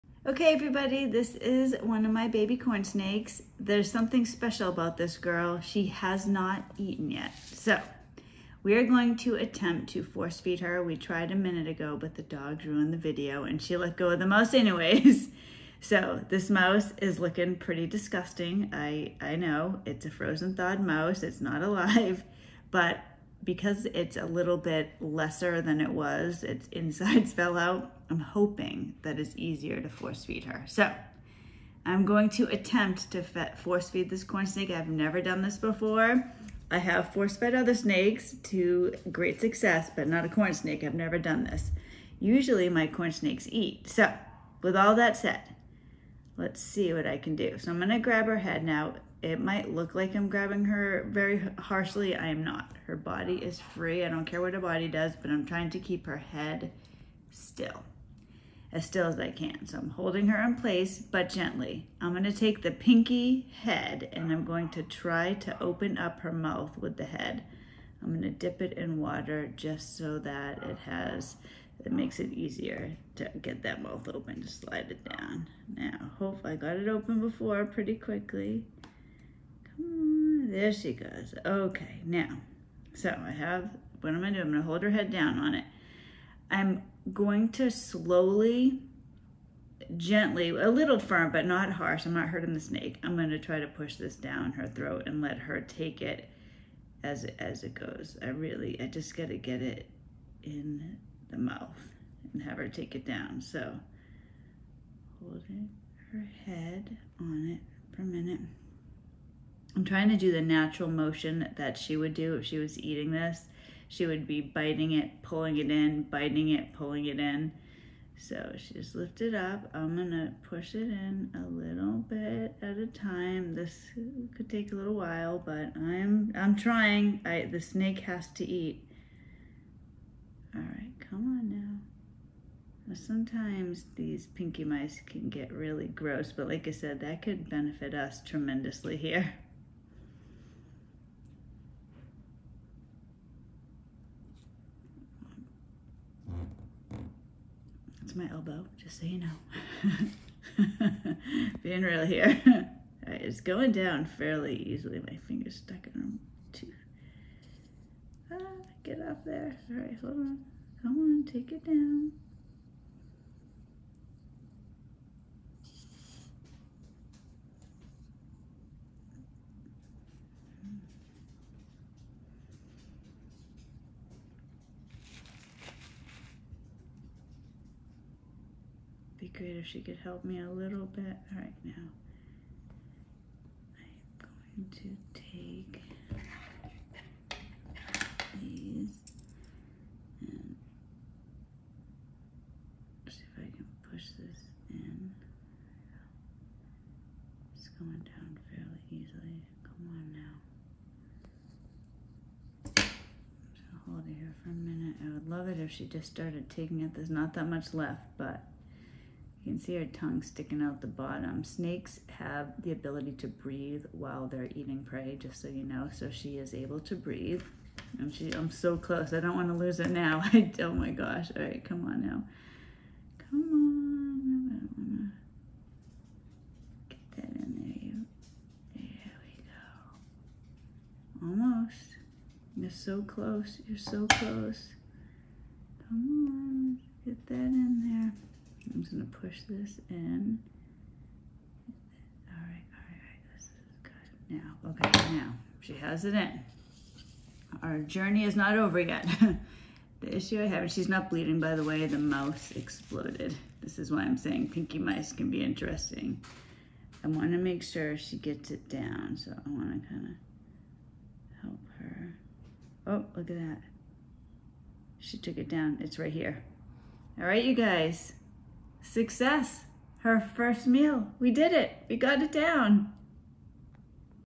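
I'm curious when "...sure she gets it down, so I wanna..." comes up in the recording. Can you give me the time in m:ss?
4:17.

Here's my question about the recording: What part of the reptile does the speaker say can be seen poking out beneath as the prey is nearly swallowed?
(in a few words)
Her tongue.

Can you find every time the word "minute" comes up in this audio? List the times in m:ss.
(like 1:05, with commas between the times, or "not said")
0:11, 1:48, 3:24.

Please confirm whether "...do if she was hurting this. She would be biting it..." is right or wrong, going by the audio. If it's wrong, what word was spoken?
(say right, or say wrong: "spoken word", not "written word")
wrong: "eating", not "hurting".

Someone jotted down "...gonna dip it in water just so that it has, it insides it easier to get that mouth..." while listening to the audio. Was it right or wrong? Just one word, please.
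wrong.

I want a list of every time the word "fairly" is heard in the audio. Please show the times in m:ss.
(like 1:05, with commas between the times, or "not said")
2:34, 3:18.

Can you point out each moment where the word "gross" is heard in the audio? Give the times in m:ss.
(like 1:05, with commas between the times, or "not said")
2:15.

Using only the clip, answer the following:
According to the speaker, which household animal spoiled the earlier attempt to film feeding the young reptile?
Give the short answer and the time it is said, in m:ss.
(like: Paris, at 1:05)
The dog, at 0:12.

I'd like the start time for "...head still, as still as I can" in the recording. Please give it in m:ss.
0:56.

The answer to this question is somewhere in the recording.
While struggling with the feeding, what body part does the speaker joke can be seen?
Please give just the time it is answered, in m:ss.
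2:28.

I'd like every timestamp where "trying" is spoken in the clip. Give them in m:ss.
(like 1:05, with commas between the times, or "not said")
0:55, 1:49, 2:06.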